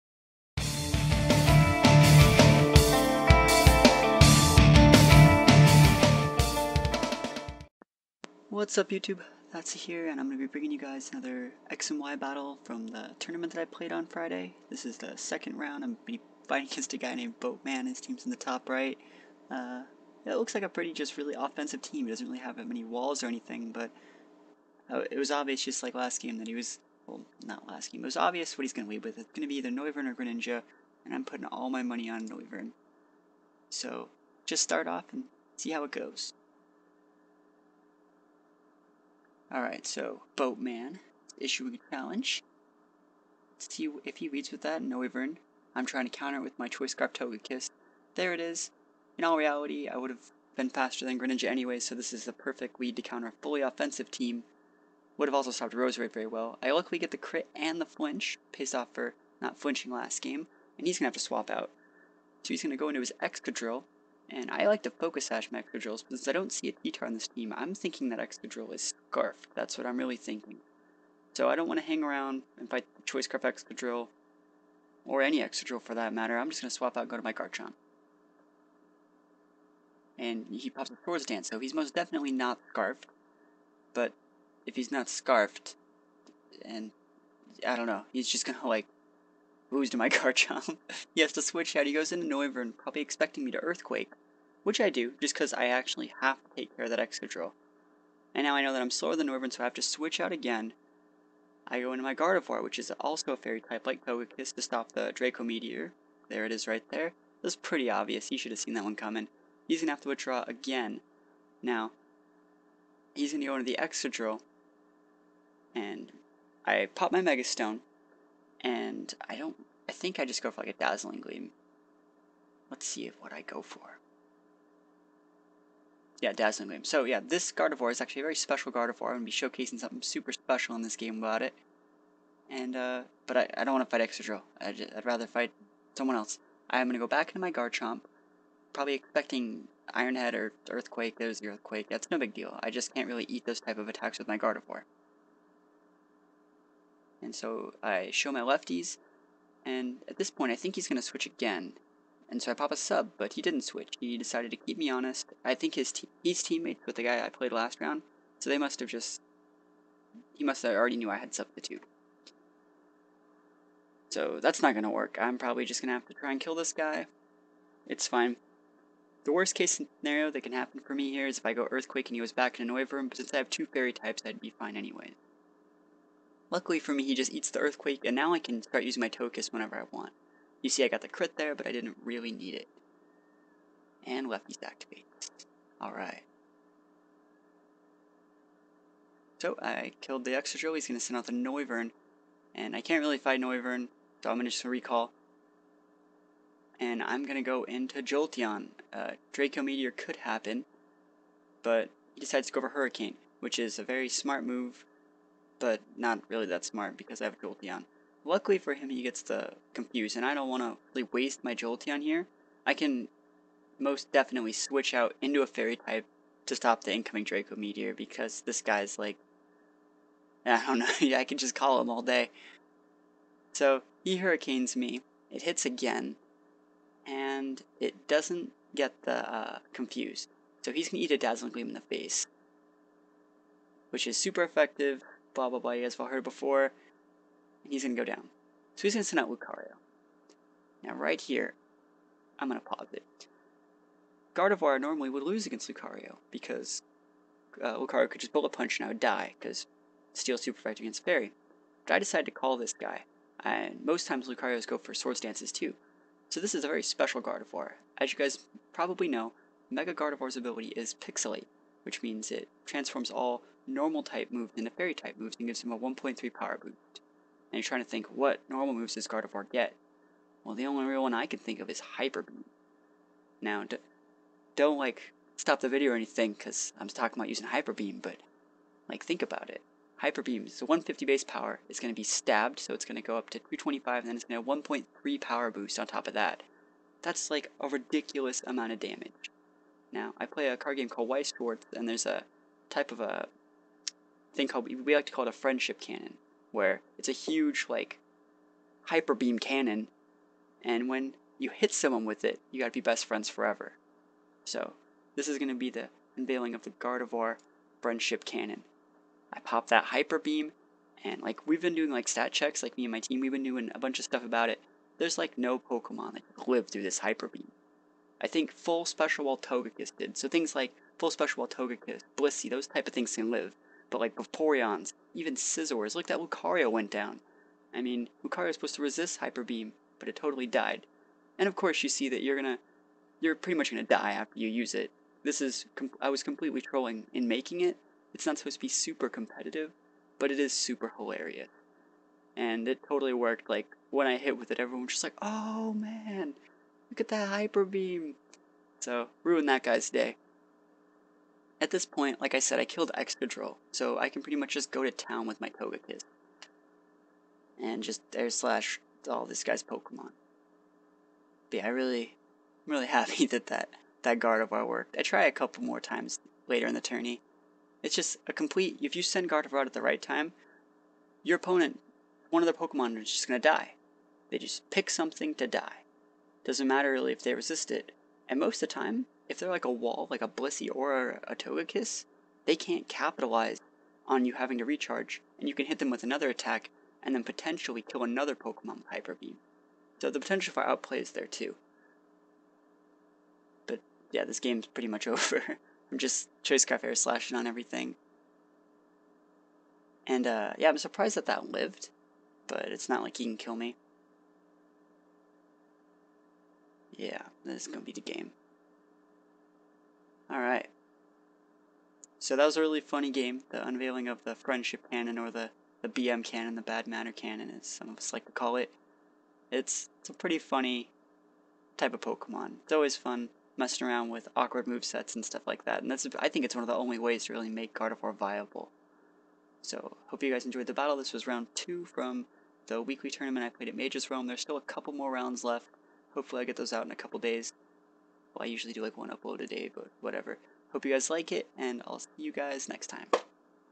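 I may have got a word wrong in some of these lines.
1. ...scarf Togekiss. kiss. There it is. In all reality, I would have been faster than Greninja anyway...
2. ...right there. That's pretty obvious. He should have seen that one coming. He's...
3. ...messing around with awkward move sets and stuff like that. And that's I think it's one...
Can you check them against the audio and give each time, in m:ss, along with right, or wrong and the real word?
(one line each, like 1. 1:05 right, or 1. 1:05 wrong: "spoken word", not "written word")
1. 0:46 right
2. 1:46 right
3. 7:03 right.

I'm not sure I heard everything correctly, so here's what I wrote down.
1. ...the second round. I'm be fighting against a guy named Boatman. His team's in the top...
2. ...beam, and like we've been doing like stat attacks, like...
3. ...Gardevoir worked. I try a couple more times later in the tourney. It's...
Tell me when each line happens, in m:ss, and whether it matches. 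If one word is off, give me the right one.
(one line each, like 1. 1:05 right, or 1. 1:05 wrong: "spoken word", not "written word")
1. 0:14 right
2. 5:10 wrong: "checks", not "attacks"
3. 6:04 right.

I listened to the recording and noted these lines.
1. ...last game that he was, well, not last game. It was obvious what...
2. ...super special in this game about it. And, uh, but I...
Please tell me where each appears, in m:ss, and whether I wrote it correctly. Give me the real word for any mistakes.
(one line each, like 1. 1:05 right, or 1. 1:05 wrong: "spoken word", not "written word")
1. 0:25 right
2. 2:10 right.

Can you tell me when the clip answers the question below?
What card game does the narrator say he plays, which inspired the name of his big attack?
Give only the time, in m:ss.
4:51.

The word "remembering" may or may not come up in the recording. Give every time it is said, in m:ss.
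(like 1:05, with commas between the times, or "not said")
not said.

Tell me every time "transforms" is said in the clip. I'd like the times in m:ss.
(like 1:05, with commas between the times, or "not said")
4:22.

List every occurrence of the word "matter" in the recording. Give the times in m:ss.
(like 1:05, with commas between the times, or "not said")
1:16, 6:16.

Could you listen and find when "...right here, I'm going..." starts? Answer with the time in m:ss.
4:00.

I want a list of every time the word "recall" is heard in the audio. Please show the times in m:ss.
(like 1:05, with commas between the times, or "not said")
3:14.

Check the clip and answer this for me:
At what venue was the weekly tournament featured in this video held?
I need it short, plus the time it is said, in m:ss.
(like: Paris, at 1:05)
Mage's Realm, at 7:13.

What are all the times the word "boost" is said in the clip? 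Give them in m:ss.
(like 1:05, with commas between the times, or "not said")
4:26, 4:45.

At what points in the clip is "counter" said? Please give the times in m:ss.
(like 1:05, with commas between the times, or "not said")
0:46, 0:53.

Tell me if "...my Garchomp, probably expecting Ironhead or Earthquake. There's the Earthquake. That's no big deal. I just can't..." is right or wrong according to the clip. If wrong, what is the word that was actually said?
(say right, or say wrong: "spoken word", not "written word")
right.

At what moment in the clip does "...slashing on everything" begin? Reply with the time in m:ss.
6:36.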